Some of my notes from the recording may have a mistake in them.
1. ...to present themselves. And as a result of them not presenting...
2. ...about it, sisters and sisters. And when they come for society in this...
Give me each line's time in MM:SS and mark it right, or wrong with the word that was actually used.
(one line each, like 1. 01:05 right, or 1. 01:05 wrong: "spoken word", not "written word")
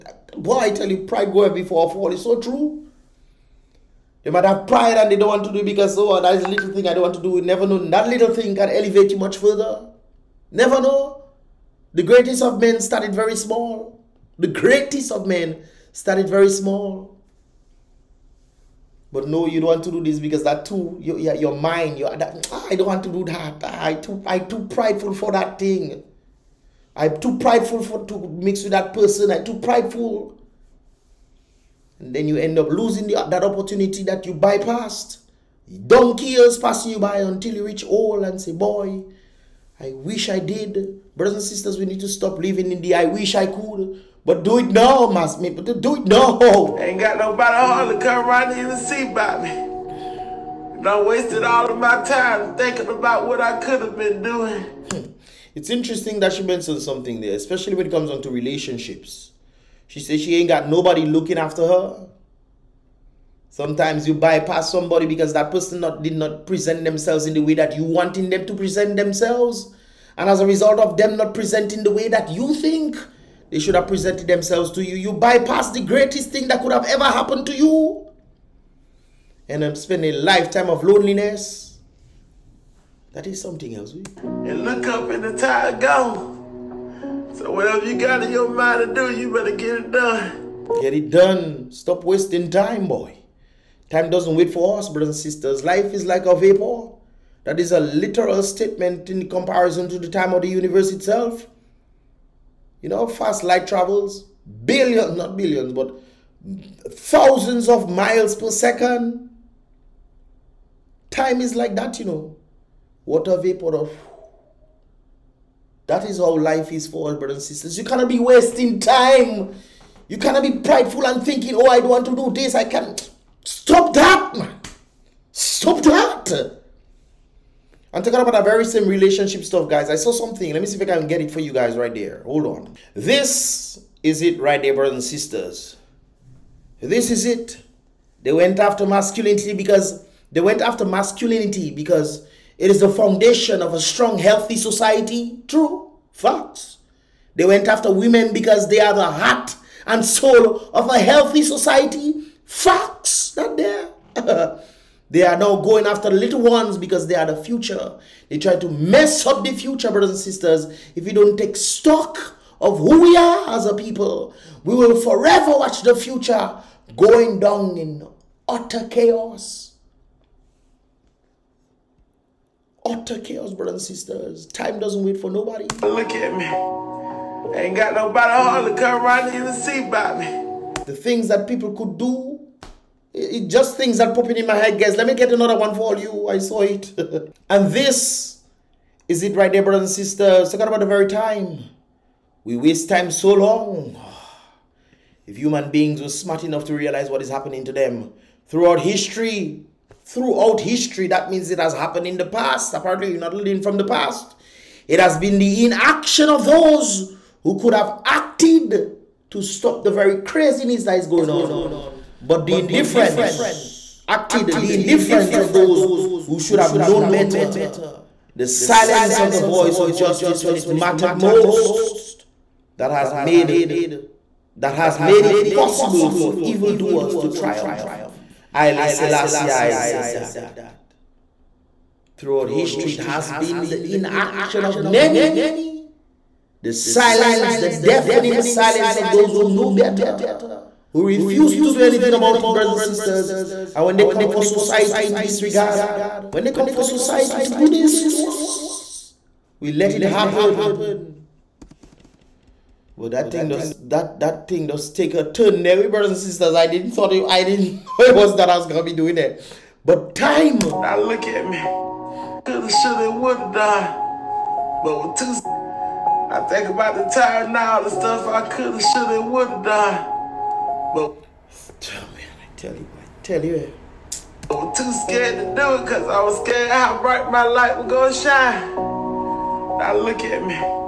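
1. 01:08 right
2. 04:02 wrong: "brothers", not "sisters".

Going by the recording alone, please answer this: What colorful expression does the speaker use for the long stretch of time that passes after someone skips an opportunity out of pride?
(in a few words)
Donkey years.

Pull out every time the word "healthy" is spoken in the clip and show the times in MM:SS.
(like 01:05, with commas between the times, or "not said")
02:24, 02:30.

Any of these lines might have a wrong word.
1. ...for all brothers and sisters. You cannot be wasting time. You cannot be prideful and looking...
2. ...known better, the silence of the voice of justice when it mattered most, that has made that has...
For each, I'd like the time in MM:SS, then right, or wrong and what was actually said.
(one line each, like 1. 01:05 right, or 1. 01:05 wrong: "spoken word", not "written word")
1. 01:56 wrong: "thinking", not "looking"
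2. 03:36 right.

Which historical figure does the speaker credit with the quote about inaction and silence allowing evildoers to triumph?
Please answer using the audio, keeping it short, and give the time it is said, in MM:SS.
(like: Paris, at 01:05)
Haile Selassie, at 03:48.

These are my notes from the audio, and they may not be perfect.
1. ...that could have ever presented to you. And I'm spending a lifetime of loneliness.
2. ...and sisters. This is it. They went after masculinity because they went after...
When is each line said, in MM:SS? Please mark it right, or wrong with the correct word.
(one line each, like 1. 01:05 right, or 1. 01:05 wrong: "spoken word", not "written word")
1. 01:16 wrong: "happened", not "presented"
2. 02:14 right.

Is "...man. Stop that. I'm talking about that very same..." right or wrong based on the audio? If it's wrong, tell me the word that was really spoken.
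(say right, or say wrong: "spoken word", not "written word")
right.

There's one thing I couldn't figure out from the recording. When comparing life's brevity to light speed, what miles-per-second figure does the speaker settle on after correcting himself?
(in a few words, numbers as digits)
thousands.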